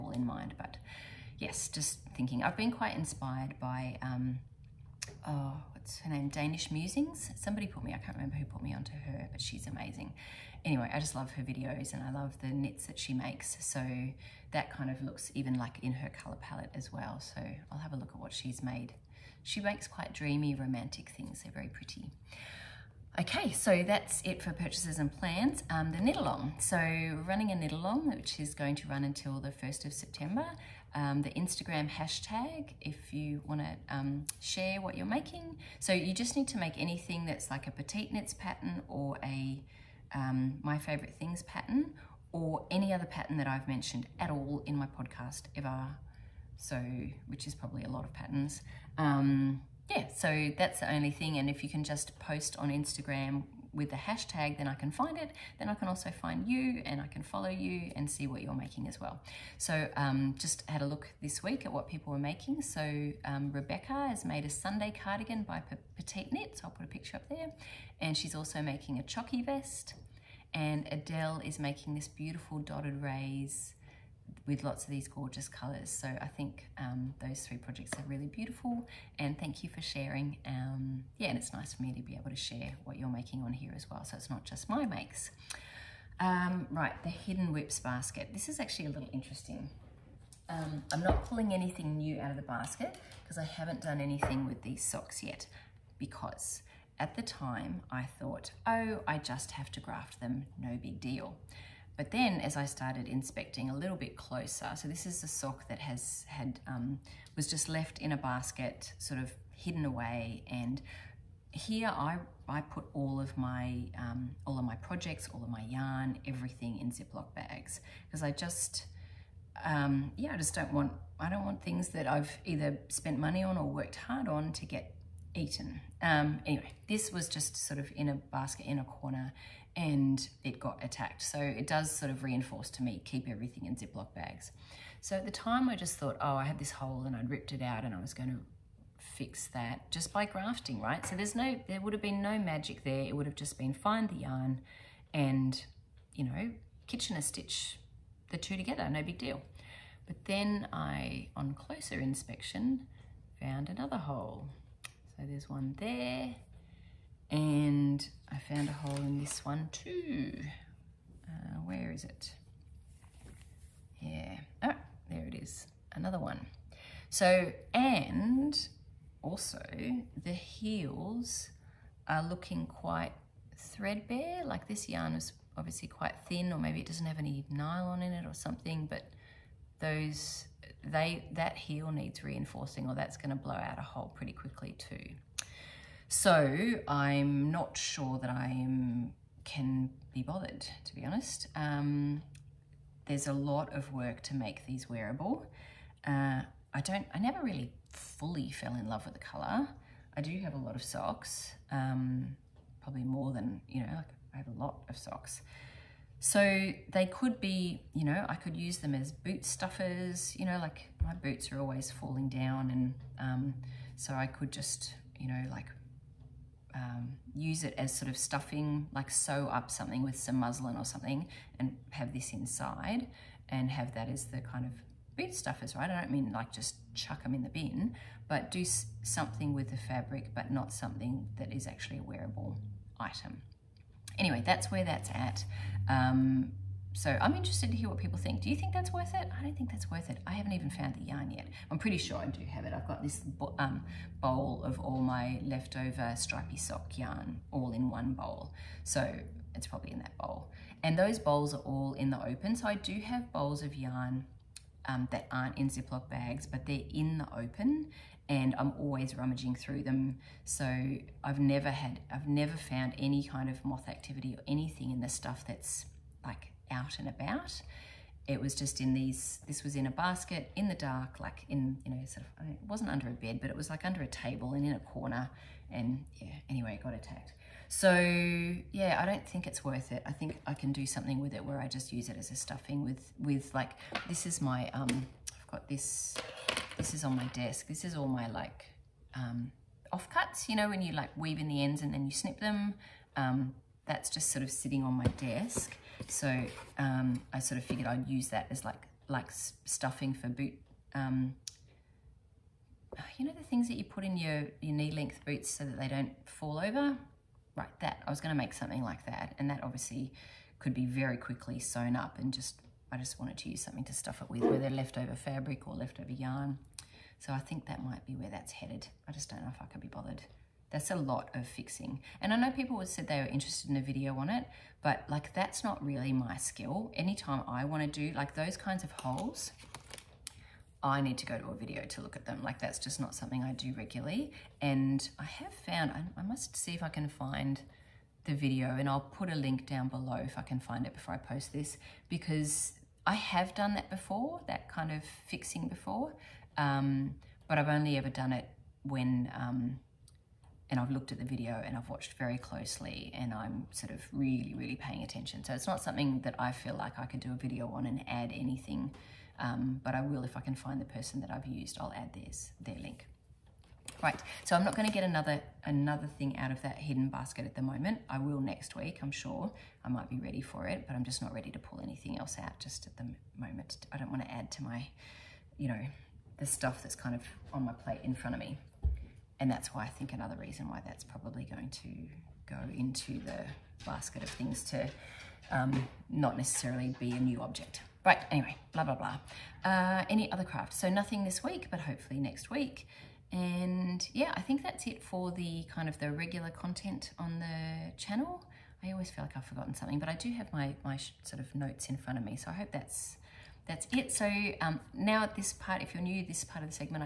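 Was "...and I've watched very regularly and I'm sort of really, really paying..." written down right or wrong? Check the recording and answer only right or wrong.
wrong.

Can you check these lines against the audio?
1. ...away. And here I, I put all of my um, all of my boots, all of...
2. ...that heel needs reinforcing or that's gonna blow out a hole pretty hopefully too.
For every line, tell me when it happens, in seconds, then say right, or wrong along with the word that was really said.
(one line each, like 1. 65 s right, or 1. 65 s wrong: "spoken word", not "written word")
1. 109 s wrong: "projects", not "boots"
2. 181 s wrong: "quickly", not "hopefully".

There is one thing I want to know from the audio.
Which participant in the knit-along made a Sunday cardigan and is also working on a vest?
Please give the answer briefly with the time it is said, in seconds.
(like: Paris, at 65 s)
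Rebecca, at 63 s.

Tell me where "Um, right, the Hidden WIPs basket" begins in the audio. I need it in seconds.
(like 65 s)
86 s.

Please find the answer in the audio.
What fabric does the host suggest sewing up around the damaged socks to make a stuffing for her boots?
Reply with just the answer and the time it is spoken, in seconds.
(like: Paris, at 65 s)
muslin, at 220 s.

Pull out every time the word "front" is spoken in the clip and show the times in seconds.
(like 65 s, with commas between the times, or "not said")
378 s, 401 s.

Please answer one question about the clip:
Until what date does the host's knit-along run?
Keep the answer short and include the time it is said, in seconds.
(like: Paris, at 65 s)
1st of September, at 29 s.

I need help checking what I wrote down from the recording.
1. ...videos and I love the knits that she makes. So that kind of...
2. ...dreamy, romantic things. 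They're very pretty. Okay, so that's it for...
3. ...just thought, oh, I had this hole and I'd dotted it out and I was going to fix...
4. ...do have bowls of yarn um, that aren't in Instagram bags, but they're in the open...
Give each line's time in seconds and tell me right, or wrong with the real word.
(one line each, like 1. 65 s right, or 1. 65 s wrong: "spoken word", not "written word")
1. 11 s right
2. 20 s right
3. 135 s wrong: "ripped", not "dotted"
4. 252 s wrong: "Ziploc", not "Instagram".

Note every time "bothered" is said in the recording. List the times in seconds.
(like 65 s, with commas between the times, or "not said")
190 s, 319 s.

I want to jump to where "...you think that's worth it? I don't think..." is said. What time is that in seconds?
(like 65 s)
238 s.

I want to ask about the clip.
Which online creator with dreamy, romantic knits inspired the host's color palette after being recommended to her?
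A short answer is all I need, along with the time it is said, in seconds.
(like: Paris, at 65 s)
Danish Musings, at 6 s.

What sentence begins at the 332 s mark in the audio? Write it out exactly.
Like that's just not something I do regularly.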